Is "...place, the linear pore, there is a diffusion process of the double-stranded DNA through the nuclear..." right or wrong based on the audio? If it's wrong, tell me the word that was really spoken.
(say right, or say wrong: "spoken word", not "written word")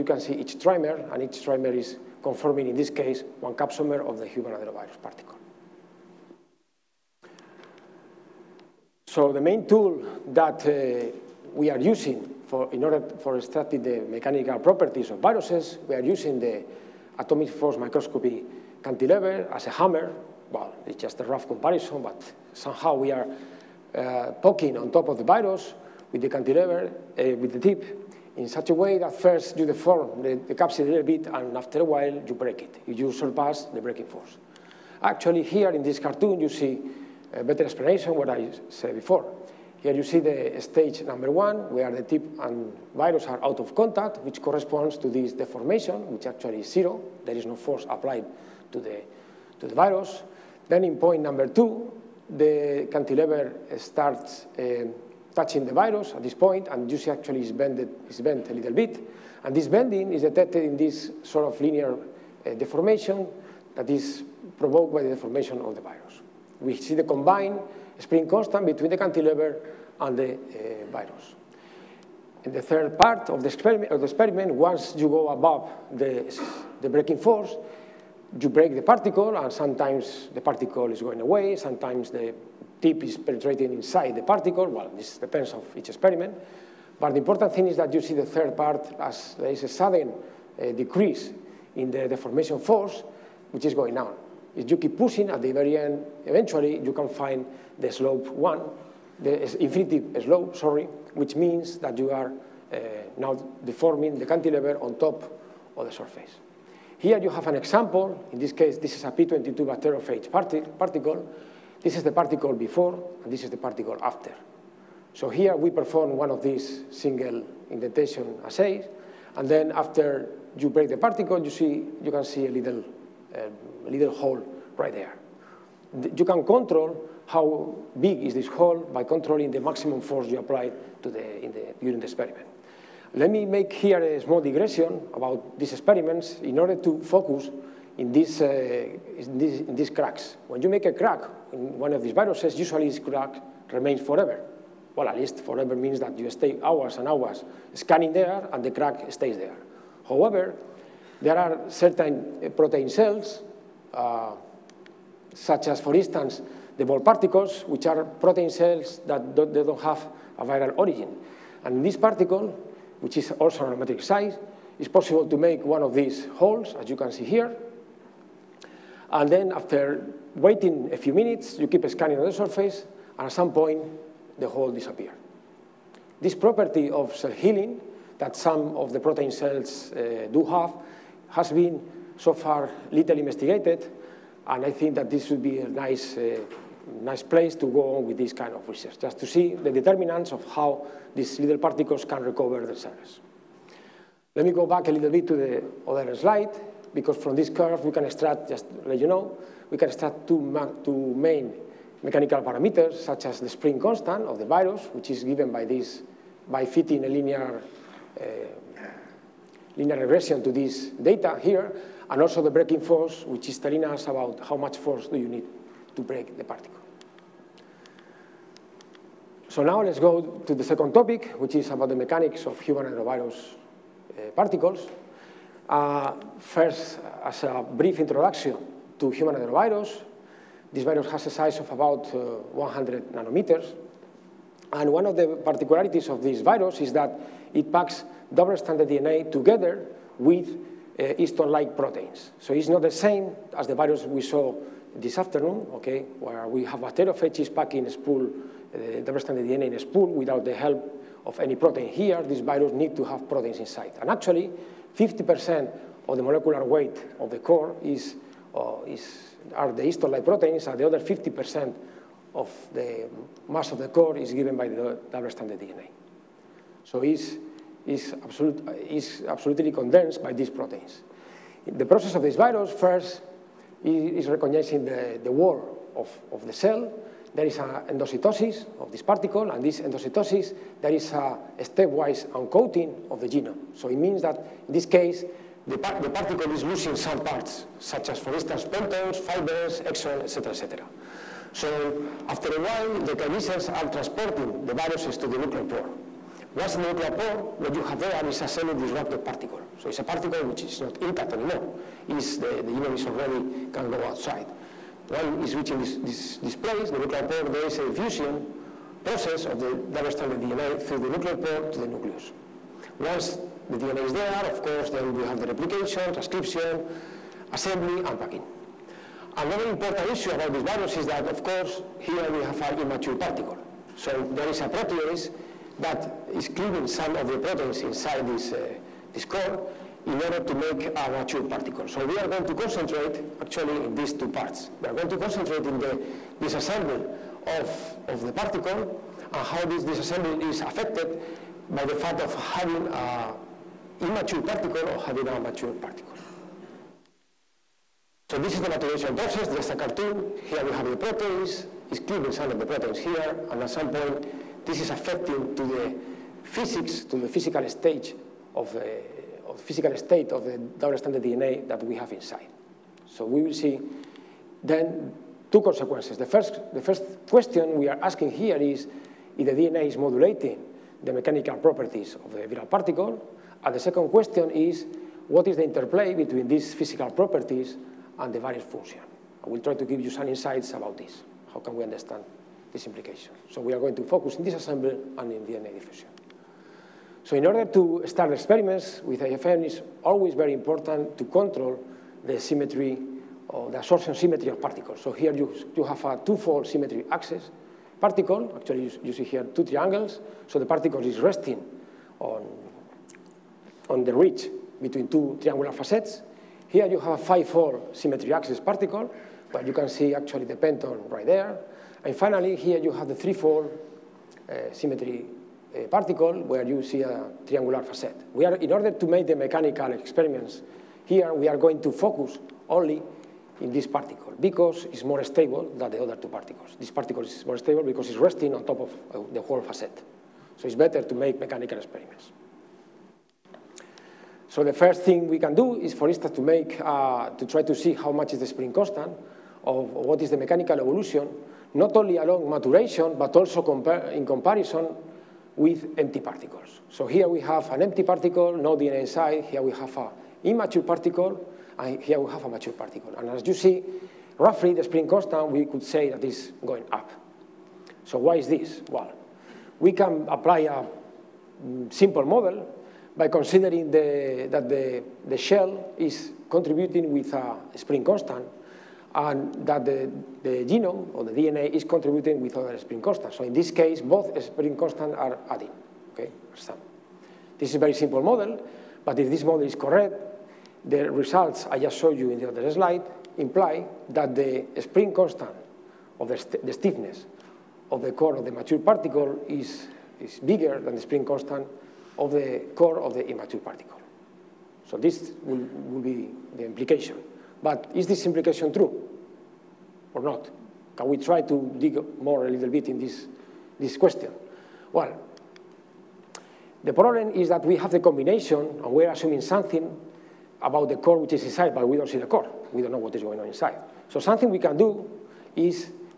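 wrong: "nuclear", not "linear".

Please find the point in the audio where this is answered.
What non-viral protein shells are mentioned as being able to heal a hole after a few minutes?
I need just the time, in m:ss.
2:36.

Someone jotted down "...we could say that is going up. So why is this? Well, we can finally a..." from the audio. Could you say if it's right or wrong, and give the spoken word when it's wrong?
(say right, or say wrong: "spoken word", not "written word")
wrong: "apply", not "finally".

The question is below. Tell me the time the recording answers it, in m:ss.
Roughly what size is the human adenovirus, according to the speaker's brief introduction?
3:52.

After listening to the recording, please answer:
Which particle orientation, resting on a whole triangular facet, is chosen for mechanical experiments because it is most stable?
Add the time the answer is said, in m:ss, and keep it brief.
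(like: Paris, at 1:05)
3-4 symmetry, at 6:53.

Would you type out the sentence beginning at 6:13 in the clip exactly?
And the second question is what is the interplay between these physical properties and the variance function.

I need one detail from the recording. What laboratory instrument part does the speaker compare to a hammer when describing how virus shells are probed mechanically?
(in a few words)
atomic force microscopy cantilever.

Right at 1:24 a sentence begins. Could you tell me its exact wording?
Well, this depends of each experiment.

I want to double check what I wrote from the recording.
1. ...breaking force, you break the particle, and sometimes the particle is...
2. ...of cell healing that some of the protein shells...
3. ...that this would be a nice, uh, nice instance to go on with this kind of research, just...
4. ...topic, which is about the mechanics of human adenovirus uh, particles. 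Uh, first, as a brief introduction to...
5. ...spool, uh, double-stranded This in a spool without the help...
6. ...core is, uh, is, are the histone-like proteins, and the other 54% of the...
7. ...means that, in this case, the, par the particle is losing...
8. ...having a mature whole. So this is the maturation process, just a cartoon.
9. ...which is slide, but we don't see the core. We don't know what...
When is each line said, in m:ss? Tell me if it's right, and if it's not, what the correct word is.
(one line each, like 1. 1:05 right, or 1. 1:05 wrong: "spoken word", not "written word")
1. 1:16 right
2. 2:56 right
3. 3:04 wrong: "place", not "instance"
4. 3:40 right
5. 4:07 wrong: "DNA", not "This"
6. 4:17 wrong: "50", not "54"
7. 4:43 right
8. 5:44 wrong: "particle", not "whole"
9. 8:31 wrong: "inside", not "slide".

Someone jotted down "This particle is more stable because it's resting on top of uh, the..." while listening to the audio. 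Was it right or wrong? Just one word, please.
right.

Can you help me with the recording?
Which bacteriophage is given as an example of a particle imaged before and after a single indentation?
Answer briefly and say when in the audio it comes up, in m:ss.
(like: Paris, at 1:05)
P22, at 1:49.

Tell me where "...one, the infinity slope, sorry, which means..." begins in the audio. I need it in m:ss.
1:38.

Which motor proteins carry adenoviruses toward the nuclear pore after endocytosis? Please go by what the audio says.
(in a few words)
kinesins.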